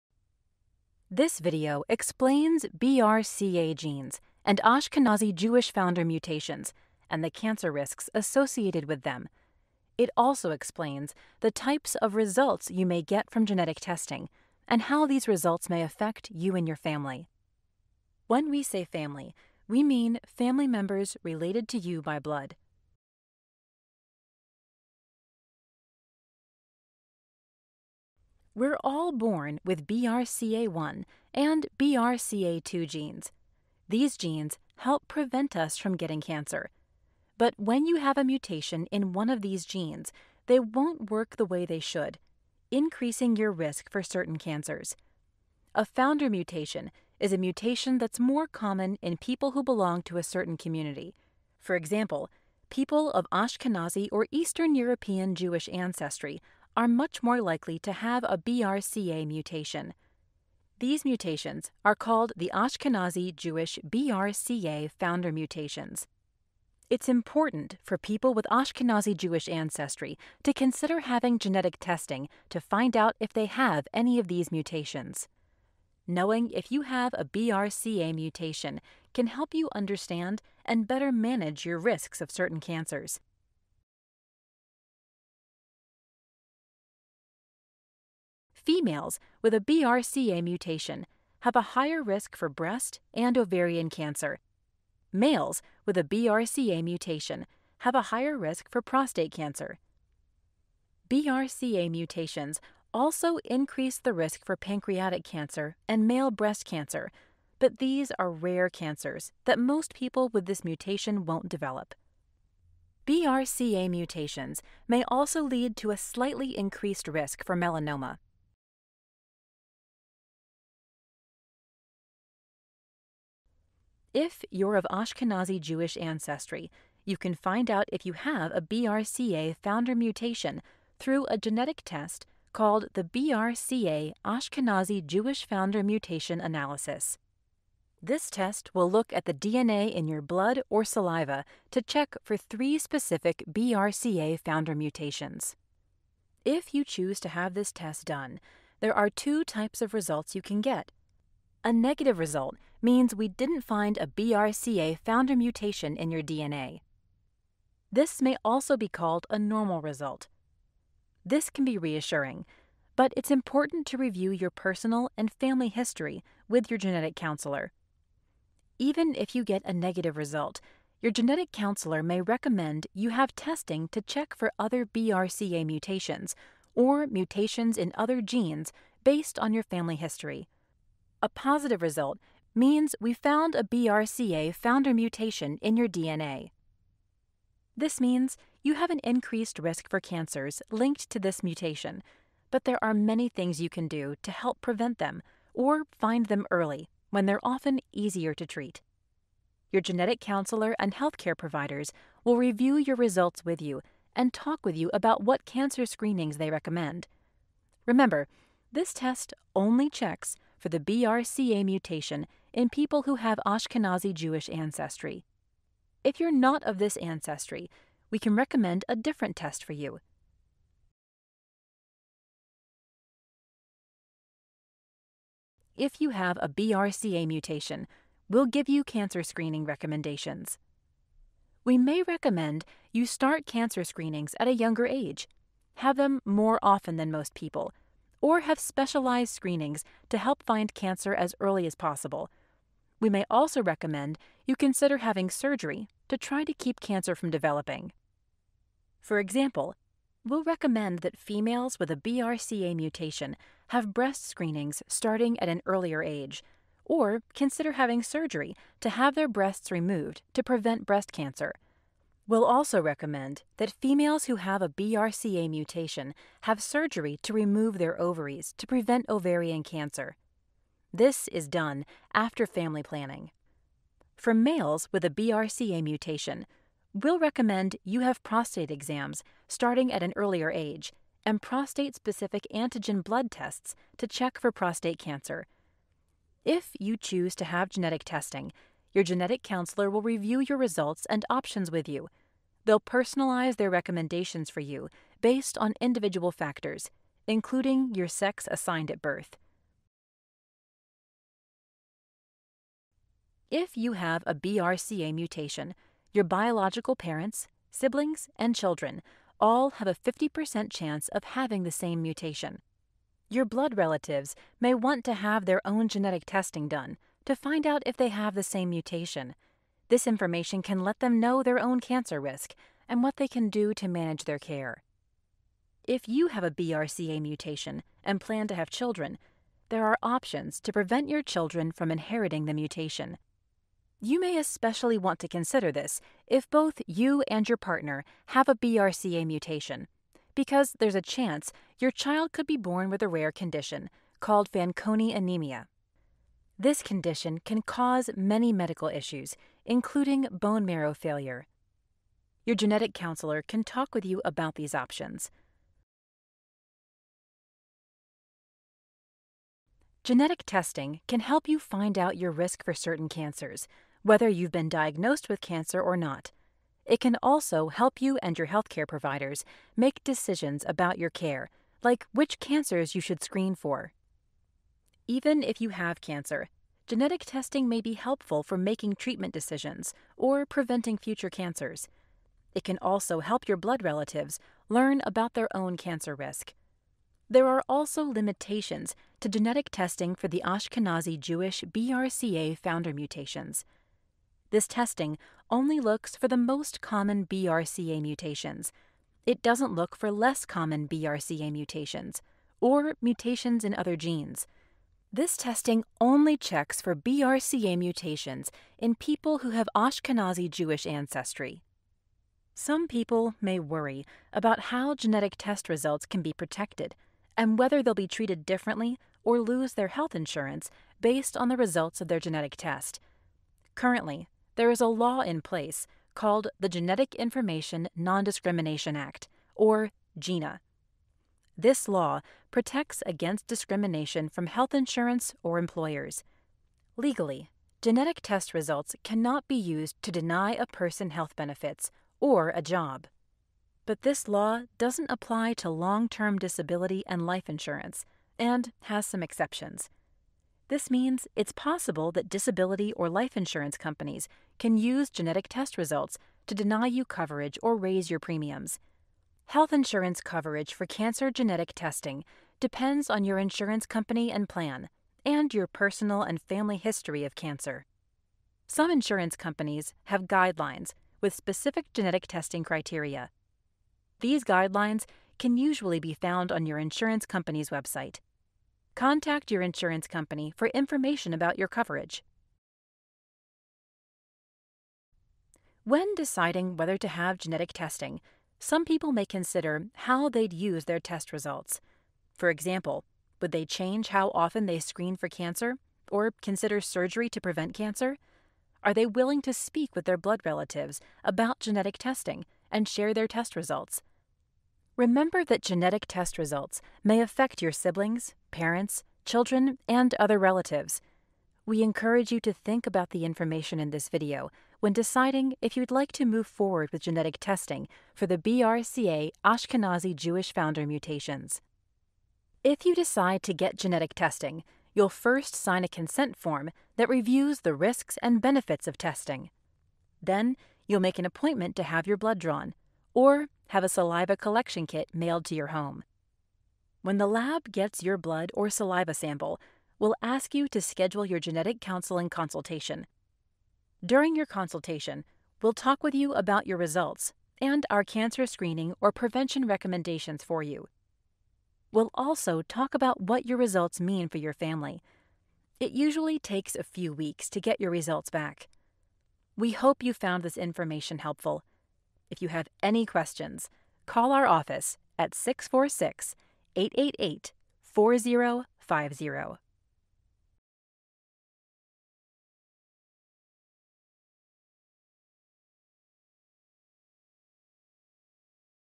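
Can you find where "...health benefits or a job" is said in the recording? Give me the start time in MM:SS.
07:21.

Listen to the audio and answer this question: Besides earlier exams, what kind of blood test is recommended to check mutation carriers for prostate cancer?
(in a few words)
prostate specific antigen.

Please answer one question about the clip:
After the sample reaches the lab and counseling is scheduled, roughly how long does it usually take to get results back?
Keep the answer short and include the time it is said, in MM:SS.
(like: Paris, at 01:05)
a few weeks, at 09:16.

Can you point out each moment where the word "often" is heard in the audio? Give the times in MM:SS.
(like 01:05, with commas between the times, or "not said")
03:17, 03:56, 08:14.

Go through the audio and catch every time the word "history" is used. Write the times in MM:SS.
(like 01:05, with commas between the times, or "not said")
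02:45, 02:59, 07:46.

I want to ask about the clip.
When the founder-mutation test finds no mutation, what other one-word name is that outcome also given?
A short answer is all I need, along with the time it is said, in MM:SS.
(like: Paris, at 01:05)
normal, at 02:39.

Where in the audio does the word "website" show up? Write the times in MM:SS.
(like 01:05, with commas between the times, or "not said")
07:57.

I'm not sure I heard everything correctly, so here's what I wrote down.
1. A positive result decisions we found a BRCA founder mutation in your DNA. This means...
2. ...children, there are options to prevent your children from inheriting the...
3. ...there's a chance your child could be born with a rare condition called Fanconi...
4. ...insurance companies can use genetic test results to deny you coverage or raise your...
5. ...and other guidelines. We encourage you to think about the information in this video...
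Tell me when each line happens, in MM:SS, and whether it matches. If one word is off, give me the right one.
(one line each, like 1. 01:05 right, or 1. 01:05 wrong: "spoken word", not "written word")
1. 03:01 wrong: "means", not "decisions"
2. 05:28 right
3. 05:40 right
4. 07:33 right
5. 08:29 wrong: "relatives", not "guidelines".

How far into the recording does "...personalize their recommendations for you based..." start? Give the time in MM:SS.
04:52.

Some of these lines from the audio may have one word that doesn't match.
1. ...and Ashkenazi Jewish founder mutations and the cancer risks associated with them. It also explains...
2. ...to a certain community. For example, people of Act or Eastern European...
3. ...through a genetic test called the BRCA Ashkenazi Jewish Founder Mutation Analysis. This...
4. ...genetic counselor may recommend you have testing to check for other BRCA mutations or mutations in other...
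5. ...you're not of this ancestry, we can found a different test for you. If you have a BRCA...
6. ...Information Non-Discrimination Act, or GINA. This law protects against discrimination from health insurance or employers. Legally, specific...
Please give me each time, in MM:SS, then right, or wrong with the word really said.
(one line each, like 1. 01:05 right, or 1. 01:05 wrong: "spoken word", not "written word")
1. 00:04 right
2. 00:50 wrong: "Ashkenazi", not "Act"
3. 02:10 right
4. 02:51 right
5. 03:36 wrong: "recommend", not "found"
6. 07:07 wrong: "genetic", not "specific".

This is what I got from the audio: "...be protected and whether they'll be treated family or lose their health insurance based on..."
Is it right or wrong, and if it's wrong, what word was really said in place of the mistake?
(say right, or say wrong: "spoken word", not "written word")
wrong: "differently", not "family".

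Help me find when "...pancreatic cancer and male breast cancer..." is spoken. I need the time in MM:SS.
01:44.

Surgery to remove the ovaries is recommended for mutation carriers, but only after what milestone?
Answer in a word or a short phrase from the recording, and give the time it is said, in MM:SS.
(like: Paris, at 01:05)
family planning, at 04:32.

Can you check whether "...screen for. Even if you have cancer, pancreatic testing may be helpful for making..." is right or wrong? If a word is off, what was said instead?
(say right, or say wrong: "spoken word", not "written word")
wrong: "genetic", not "pancreatic".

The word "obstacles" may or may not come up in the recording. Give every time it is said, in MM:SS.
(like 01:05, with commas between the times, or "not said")
not said.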